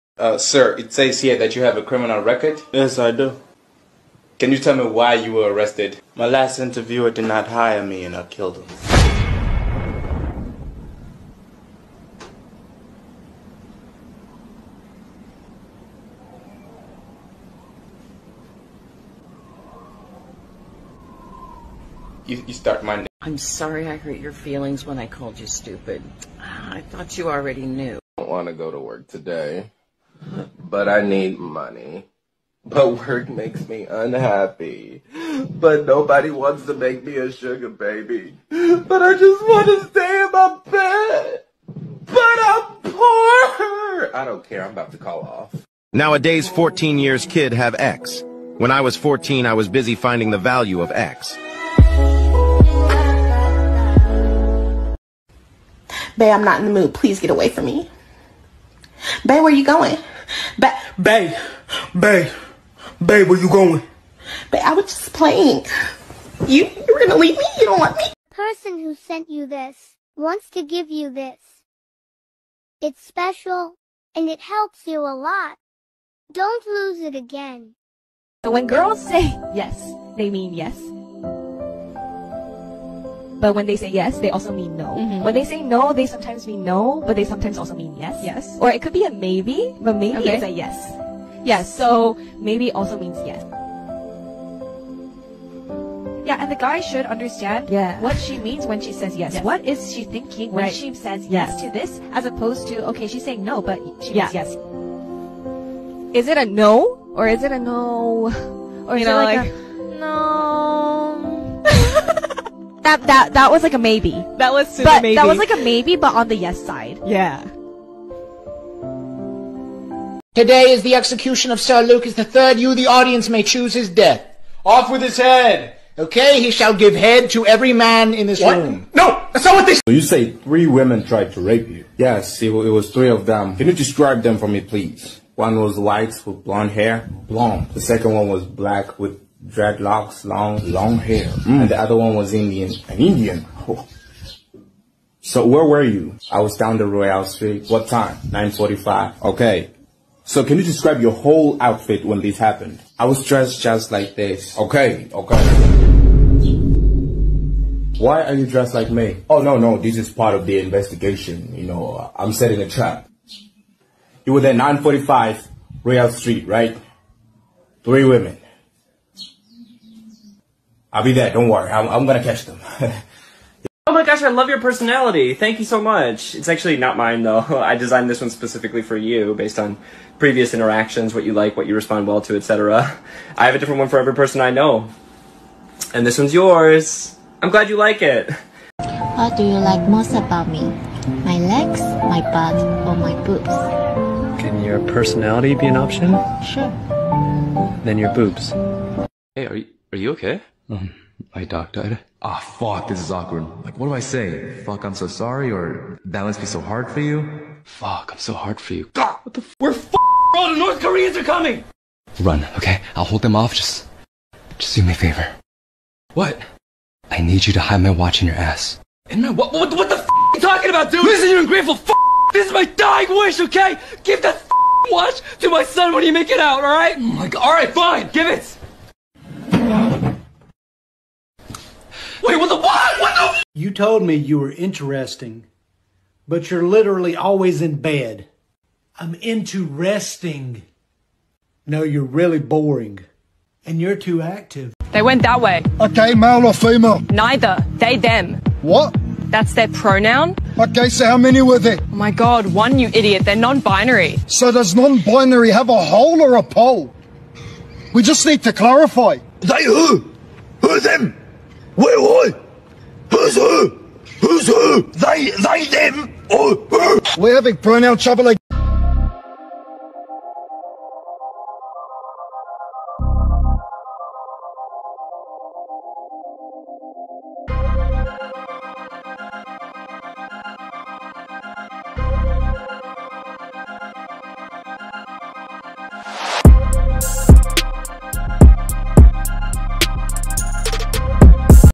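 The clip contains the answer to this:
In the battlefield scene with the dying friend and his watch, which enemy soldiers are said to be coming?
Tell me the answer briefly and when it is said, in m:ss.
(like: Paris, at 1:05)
North Koreans, at 3:30.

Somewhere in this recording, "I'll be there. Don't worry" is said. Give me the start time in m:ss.
2:50.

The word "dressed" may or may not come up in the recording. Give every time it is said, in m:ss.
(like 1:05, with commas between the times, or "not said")
2:33, 2:38.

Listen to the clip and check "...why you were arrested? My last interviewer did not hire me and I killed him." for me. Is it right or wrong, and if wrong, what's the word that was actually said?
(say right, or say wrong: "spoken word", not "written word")
right.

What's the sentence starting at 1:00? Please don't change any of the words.
Ba babe, babe, babe, where you going?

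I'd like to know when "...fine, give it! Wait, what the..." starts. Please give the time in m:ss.
3:47.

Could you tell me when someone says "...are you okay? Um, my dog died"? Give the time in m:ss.
3:19.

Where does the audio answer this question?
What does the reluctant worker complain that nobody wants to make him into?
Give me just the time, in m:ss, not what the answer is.
0:37.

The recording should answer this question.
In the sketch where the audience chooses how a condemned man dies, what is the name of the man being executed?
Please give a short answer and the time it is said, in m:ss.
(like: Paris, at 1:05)
Sir Lucas the Third, at 2:01.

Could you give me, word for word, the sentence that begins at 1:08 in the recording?
The person who sent you this wants to give you this.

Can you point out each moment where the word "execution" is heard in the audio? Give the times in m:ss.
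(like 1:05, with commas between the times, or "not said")
2:00.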